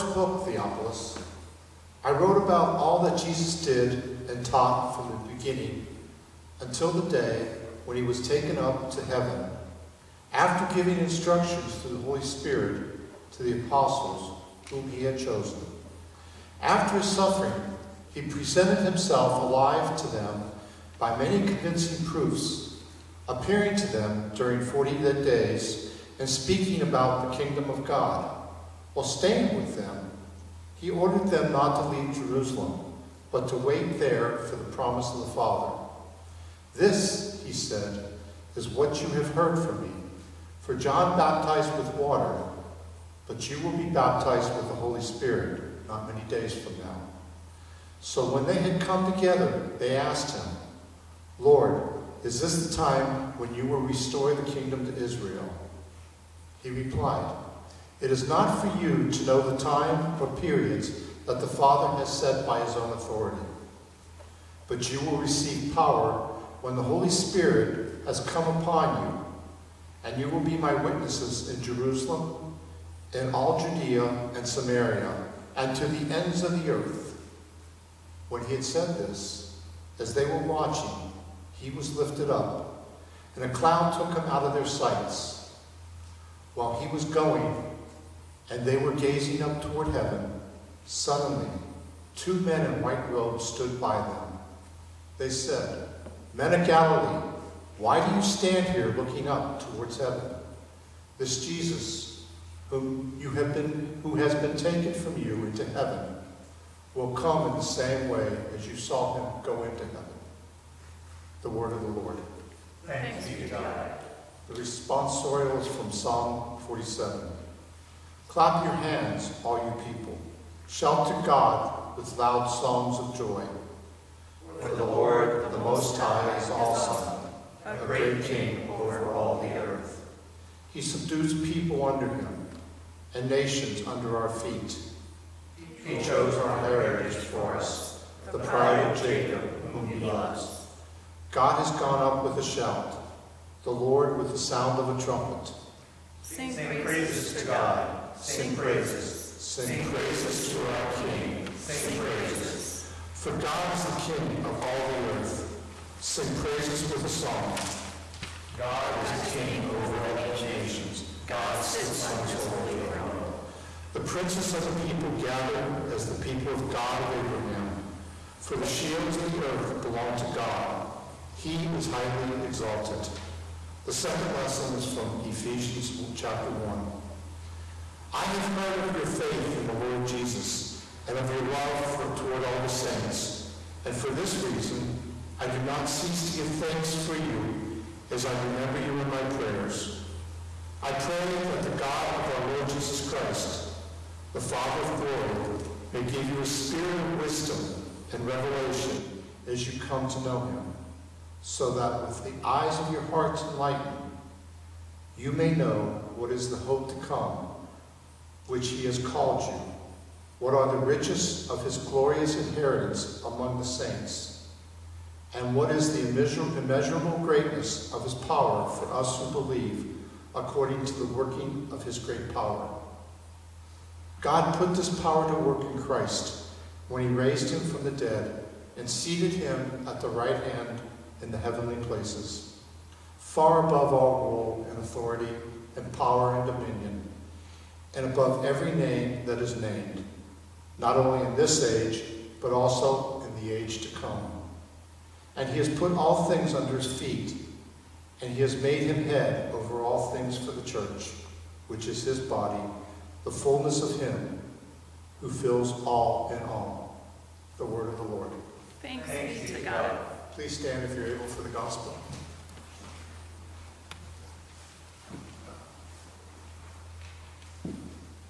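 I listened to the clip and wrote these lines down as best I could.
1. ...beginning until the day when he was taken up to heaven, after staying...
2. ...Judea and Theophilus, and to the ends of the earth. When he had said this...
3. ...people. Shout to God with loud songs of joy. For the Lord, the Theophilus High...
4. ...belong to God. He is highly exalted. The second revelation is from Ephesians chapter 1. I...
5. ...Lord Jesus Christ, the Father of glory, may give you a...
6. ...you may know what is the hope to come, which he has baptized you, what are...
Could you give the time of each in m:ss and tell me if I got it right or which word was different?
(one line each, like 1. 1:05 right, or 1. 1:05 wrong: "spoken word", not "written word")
1. 0:05 wrong: "giving", not "staying"
2. 1:13 wrong: "Samaria", not "Theophilus"
3. 1:59 wrong: "Most", not "Theophilus"
4. 2:49 wrong: "lesson", not "revelation"
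5. 3:12 right
6. 3:25 wrong: "called", not "baptized".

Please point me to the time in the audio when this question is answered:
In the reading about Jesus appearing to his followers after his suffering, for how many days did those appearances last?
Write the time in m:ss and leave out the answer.
0:24.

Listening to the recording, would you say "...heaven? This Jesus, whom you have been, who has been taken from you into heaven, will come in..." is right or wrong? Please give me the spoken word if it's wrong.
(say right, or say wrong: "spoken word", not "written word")
right.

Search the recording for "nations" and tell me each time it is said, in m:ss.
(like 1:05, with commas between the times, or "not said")
2:13, 2:40.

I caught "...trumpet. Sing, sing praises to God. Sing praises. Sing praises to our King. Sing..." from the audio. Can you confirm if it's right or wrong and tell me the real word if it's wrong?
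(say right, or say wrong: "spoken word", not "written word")
right.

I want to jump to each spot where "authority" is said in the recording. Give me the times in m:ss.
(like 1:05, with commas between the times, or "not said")
1:02, 3:54.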